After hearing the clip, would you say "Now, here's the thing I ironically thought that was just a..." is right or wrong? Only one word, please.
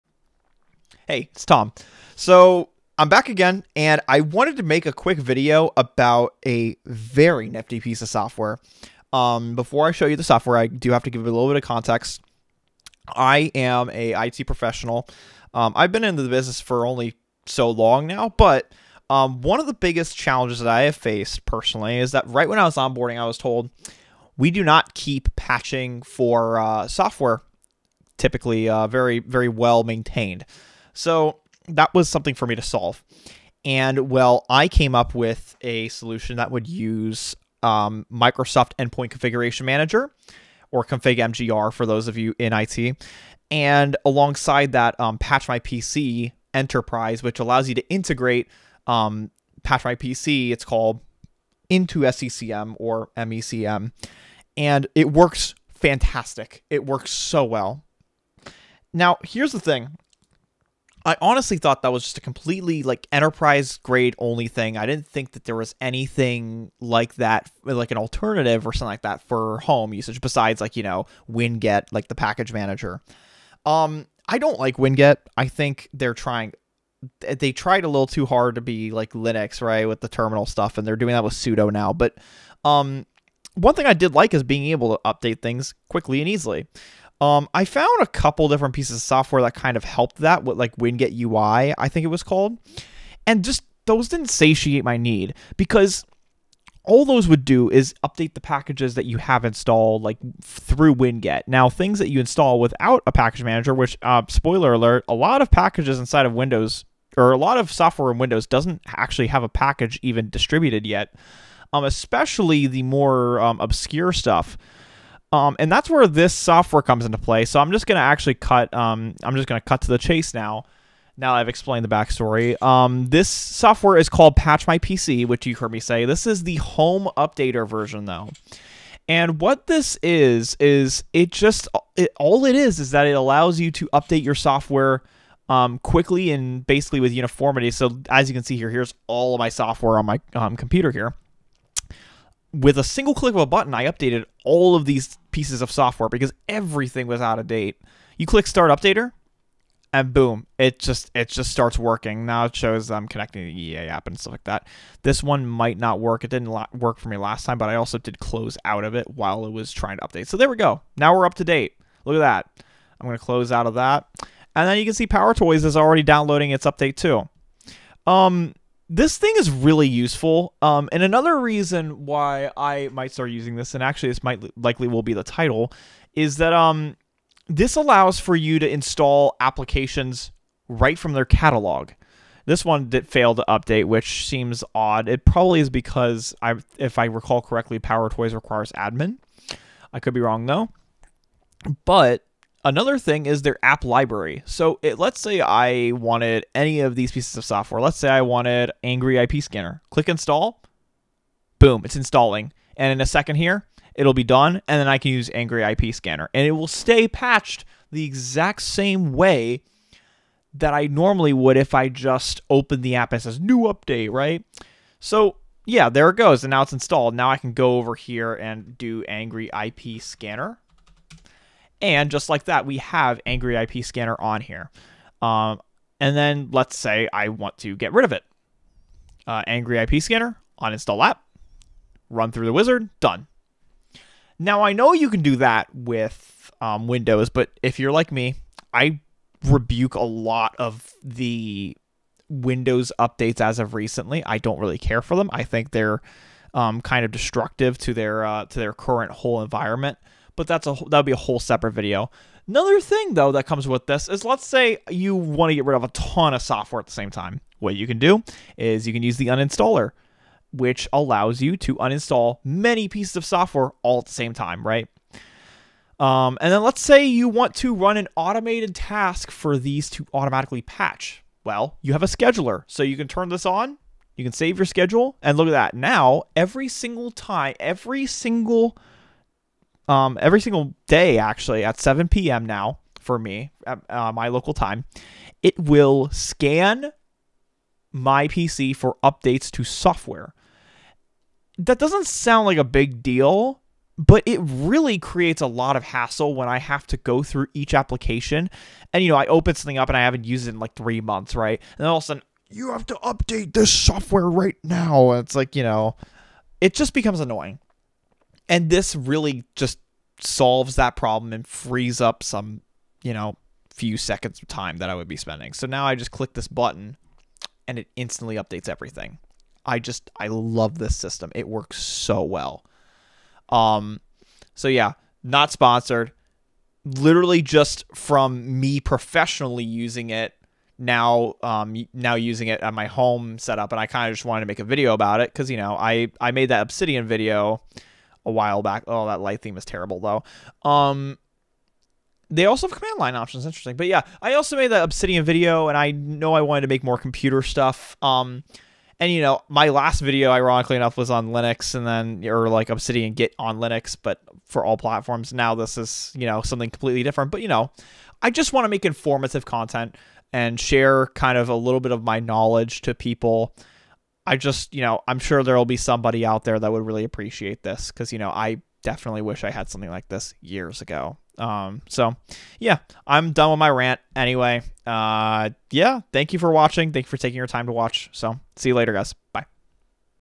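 wrong.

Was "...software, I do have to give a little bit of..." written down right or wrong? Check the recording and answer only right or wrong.
right.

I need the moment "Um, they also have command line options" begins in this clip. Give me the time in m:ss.
5:40.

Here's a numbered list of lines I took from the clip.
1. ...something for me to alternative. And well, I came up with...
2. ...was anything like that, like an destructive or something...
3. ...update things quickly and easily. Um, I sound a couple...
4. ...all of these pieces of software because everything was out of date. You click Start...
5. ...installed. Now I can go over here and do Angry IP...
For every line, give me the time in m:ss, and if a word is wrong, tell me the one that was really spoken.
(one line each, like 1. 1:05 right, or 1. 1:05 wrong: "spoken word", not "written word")
1. 0:32 wrong: "solve", not "alternative"
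2. 1:05 wrong: "alternative", not "destructive"
3. 1:25 wrong: "found", not "sound"
4. 2:24 right
5. 3:36 right.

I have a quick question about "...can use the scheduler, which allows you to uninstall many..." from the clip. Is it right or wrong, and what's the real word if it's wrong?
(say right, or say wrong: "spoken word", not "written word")
wrong: "uninstaller", not "scheduler".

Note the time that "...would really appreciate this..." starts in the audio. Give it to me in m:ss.
6:06.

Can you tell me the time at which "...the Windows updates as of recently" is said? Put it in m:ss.
4:01.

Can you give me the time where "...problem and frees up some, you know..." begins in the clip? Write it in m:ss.
5:10.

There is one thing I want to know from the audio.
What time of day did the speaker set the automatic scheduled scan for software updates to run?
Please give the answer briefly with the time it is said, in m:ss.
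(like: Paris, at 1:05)
7 p.m., at 4:41.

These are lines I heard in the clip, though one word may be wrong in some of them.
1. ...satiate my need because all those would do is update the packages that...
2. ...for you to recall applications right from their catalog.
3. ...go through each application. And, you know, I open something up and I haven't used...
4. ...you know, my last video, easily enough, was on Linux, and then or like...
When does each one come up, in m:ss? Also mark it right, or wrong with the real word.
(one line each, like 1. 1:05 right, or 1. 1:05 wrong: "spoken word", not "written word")
1. 1:34 right
2. 2:58 wrong: "install", not "recall"
3. 4:56 right
4. 5:49 wrong: "ironically", not "easily".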